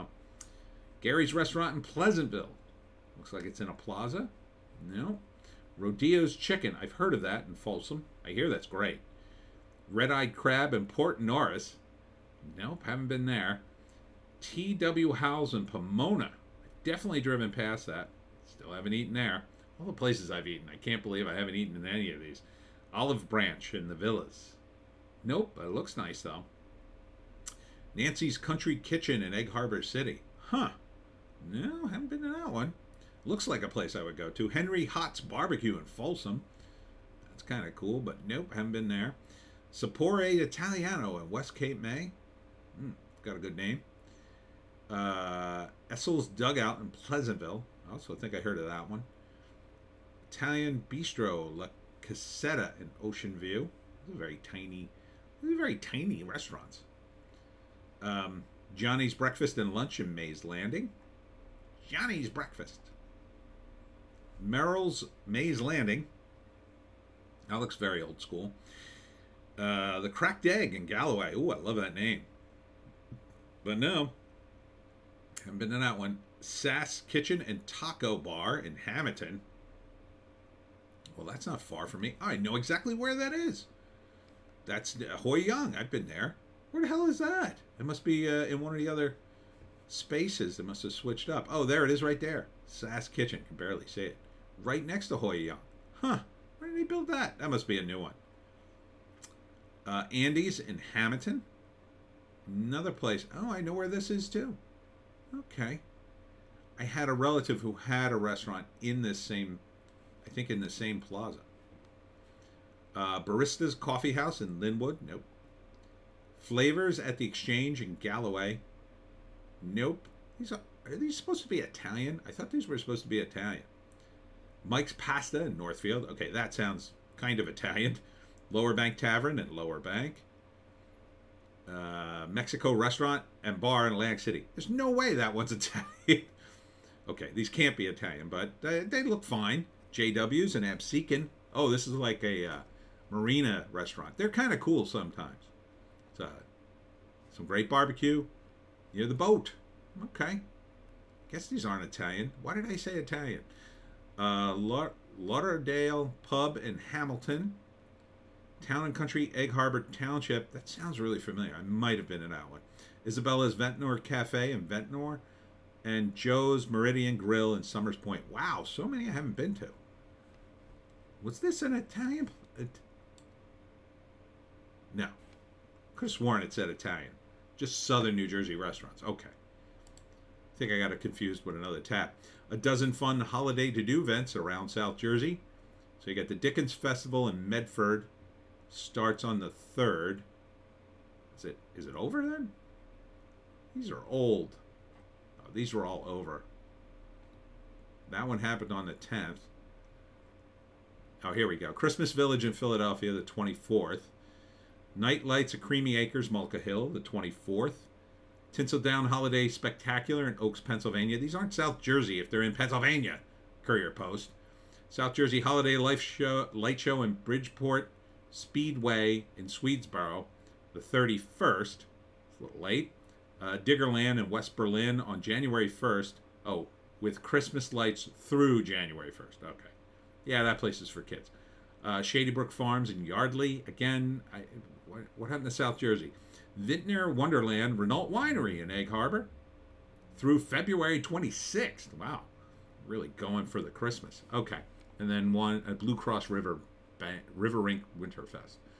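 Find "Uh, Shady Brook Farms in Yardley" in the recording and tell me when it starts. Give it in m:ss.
3:51.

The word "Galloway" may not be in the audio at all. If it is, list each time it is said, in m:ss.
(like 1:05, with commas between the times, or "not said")
1:10, 1:57.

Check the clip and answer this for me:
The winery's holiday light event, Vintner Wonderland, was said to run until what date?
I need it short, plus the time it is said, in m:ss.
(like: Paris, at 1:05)
February 26th, at 4:00.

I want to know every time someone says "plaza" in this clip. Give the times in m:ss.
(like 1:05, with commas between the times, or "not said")
0:03, 1:51.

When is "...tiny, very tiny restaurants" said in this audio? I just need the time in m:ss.
0:54.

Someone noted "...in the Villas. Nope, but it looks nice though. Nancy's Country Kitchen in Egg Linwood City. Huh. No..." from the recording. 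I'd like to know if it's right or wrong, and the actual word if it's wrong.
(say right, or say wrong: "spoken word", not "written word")
wrong: "Harbor", not "Linwood".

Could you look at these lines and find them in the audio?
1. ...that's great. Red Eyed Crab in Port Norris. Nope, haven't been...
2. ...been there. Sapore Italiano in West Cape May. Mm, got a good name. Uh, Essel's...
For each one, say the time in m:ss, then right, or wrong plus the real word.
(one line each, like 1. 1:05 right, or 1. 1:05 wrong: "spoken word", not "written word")
1. 0:08 right
2. 0:38 right.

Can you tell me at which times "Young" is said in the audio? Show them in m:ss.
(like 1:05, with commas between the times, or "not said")
1:25, 1:35.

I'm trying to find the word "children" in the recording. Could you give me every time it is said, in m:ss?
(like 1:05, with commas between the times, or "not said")
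not said.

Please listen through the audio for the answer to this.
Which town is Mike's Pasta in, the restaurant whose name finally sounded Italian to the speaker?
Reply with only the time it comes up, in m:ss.
2:04.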